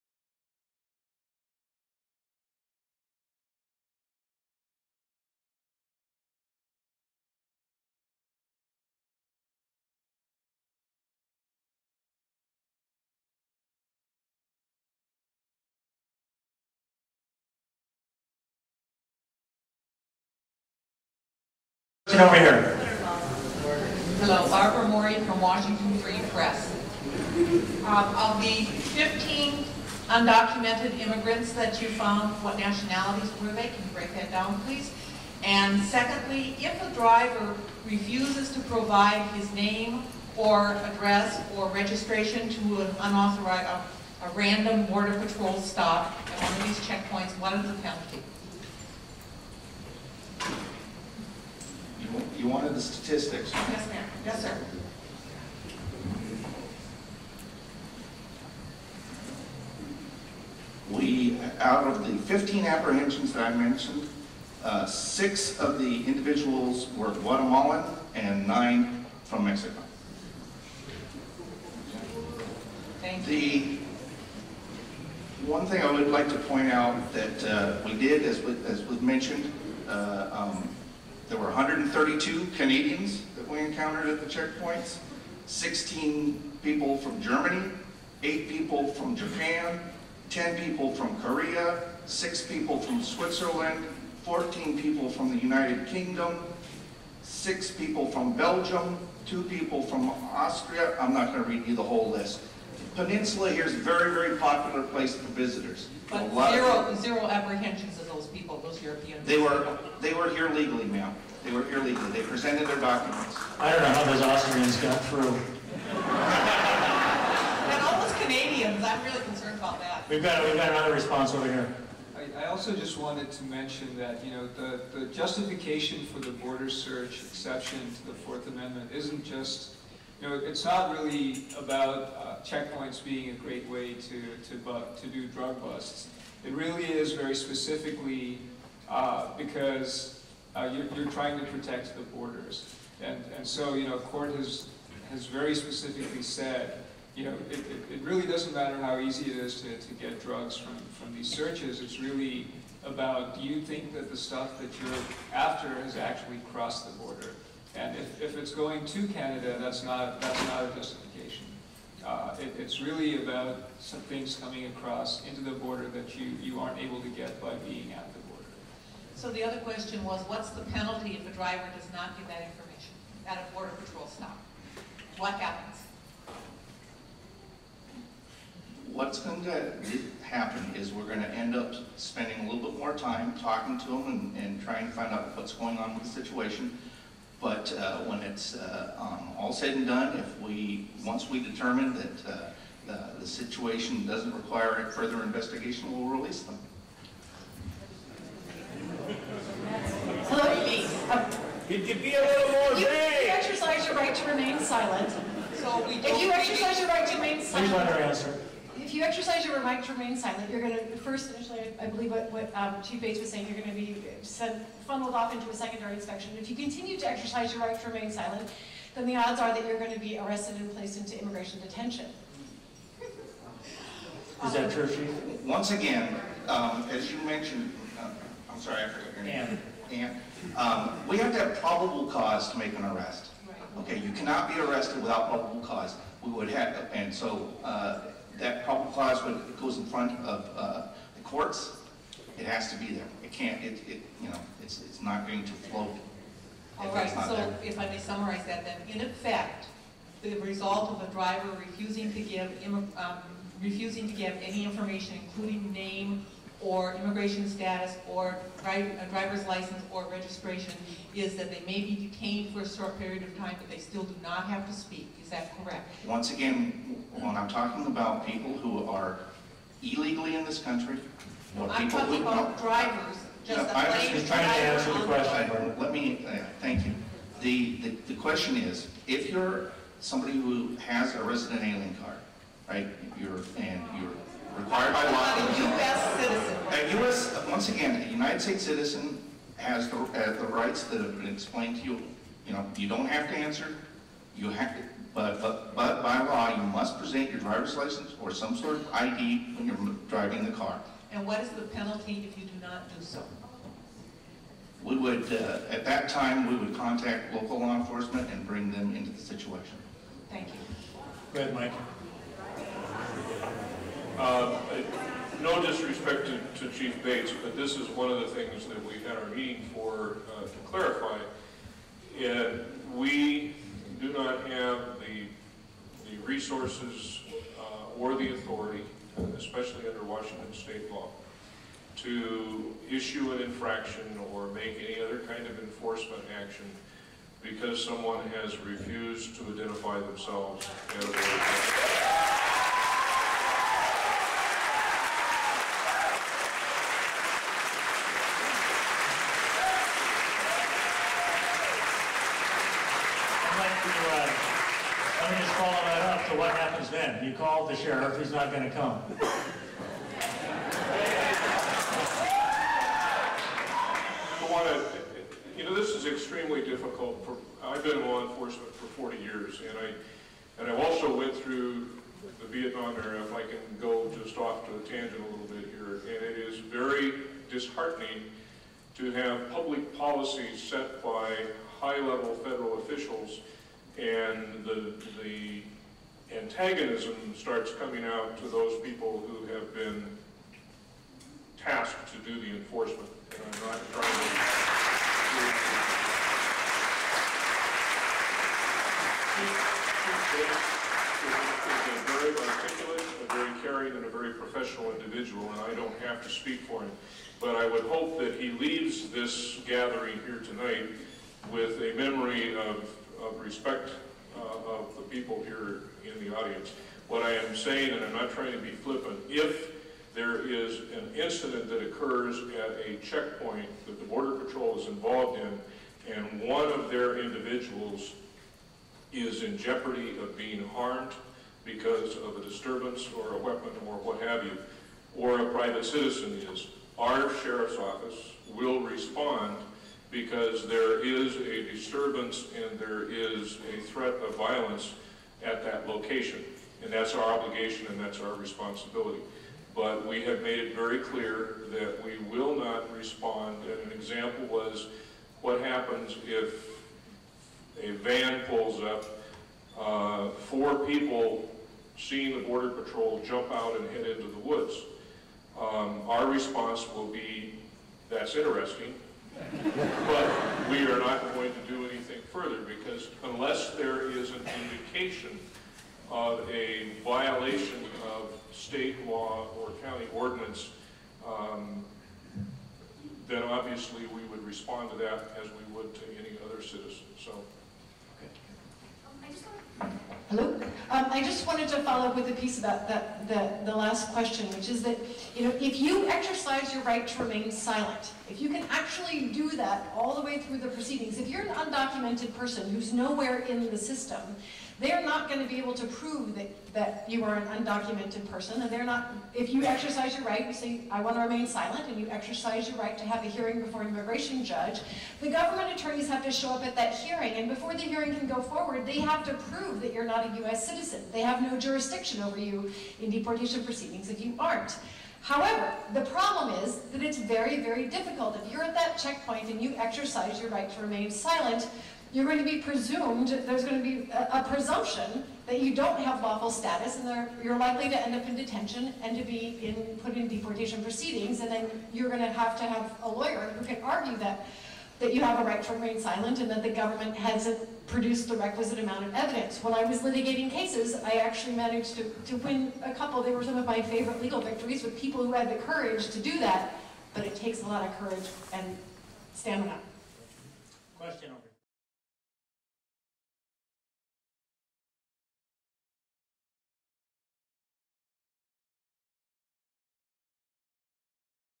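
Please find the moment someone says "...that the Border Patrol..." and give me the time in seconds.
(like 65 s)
423 s.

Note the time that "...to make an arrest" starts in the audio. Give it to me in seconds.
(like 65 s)
232 s.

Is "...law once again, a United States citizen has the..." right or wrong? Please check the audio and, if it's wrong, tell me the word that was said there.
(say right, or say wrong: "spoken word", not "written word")
right.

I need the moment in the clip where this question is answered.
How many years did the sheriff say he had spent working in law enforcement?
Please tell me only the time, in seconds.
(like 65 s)
368 s.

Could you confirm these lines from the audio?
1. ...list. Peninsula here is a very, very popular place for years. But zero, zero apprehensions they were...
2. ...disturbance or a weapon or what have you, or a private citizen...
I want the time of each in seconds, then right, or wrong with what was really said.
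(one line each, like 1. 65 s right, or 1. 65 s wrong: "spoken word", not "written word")
1. 102 s wrong: "visitors", not "years"
2. 432 s right.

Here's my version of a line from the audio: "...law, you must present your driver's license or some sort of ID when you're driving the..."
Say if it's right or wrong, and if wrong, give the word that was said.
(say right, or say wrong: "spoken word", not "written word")
right.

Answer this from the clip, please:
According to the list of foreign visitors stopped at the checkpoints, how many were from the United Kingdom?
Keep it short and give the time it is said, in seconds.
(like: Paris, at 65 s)
14, at 94 s.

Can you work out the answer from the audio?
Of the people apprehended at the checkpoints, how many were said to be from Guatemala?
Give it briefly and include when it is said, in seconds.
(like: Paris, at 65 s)
6, at 64 s.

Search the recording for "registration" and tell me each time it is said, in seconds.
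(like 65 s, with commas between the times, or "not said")
41 s, 260 s.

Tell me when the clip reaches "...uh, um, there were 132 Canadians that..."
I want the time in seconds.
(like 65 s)
79 s.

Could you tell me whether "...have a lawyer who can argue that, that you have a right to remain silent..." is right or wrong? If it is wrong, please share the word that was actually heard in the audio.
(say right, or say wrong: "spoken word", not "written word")
right.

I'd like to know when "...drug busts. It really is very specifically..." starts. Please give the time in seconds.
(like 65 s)
135 s.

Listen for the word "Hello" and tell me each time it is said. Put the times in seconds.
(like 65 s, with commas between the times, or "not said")
24 s, 490 s.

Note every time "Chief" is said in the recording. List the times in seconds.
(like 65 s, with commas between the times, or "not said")
212 s, 224 s, 316 s.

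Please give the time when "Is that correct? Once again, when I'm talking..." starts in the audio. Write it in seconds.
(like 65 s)
265 s.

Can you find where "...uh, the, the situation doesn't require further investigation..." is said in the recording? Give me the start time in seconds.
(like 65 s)
192 s.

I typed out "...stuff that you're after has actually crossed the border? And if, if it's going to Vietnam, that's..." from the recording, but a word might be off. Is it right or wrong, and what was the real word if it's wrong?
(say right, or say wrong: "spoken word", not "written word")
wrong: "Canada", not "Vietnam".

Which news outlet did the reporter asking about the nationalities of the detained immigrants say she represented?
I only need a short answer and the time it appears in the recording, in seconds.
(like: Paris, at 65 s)
Washington Free Press, at 25 s.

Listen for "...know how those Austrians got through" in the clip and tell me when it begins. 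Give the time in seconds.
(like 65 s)
113 s.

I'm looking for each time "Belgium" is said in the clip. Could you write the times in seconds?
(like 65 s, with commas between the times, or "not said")
98 s.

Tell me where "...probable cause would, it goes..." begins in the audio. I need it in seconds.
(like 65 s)
238 s.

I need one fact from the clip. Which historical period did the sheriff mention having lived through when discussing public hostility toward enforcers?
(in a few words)
Vietnam era.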